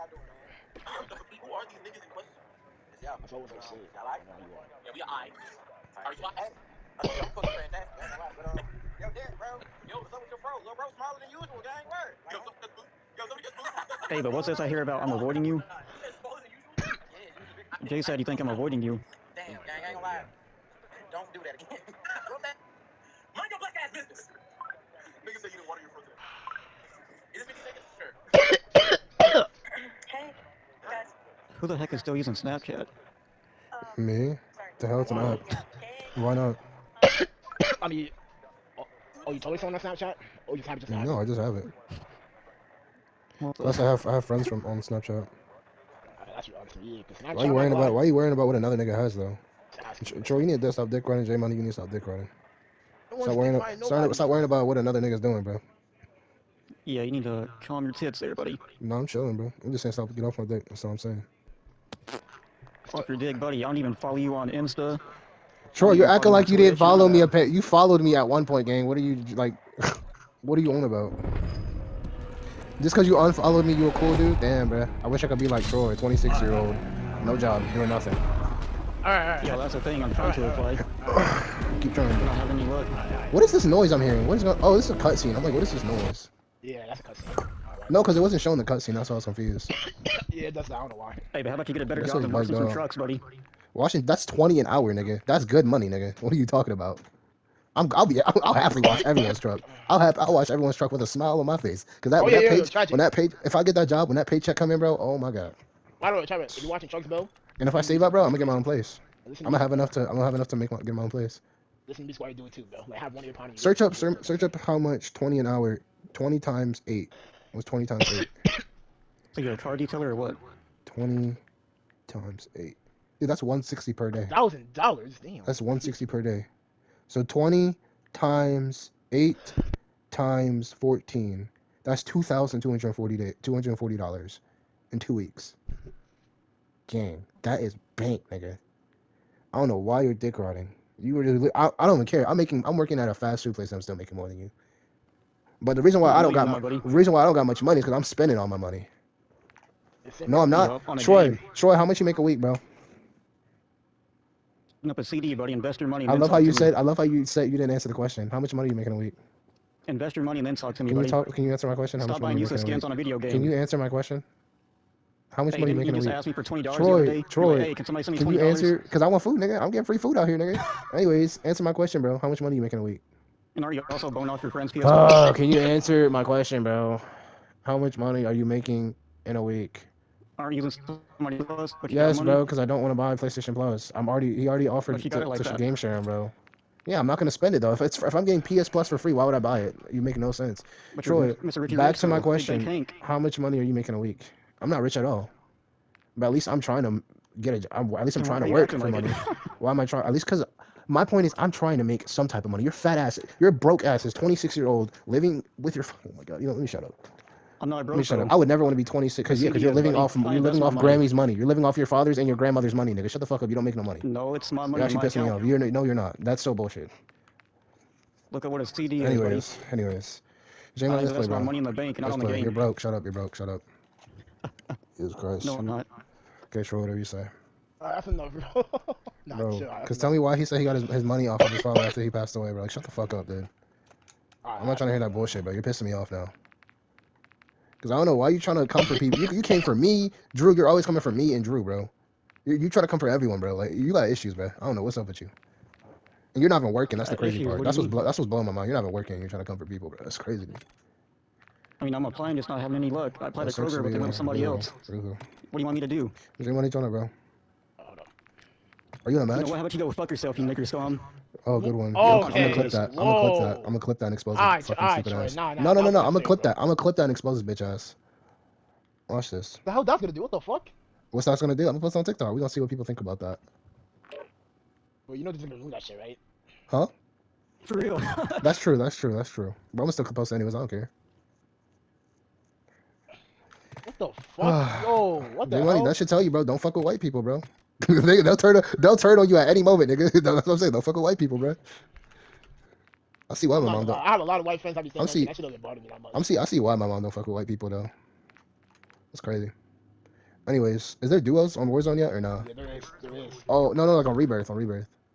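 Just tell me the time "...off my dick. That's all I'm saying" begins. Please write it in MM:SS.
01:00.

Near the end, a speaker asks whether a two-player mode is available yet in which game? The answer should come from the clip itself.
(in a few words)
Warzone.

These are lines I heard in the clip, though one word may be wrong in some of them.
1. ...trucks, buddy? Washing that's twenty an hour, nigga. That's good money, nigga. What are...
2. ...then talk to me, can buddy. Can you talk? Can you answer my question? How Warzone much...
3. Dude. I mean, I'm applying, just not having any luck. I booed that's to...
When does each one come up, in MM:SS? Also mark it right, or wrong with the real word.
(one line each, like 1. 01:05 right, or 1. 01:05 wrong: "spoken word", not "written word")
1. 01:32 right
2. 02:40 wrong: "Stop", not "Warzone"
3. 04:10 wrong: "applied", not "booed".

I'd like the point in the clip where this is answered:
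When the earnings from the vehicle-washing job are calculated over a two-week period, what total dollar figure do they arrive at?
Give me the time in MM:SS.
02:12.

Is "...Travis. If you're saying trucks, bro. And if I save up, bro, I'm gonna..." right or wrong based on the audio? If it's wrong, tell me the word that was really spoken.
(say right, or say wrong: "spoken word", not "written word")
wrong: "watching", not "saying".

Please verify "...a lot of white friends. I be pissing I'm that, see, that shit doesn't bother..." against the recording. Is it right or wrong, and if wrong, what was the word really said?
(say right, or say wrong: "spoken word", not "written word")
wrong: "saying", not "pissing".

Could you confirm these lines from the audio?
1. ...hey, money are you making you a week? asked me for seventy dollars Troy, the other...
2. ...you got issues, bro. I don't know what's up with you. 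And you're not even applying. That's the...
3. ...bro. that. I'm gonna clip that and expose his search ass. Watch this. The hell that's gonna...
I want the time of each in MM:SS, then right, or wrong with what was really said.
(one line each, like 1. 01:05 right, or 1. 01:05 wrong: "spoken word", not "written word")
1. 02:45 wrong: "twenty", not "seventy"
2. 04:03 wrong: "working", not "applying"
3. 04:26 wrong: "bitch", not "search".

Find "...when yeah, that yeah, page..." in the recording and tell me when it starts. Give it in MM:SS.
01:42.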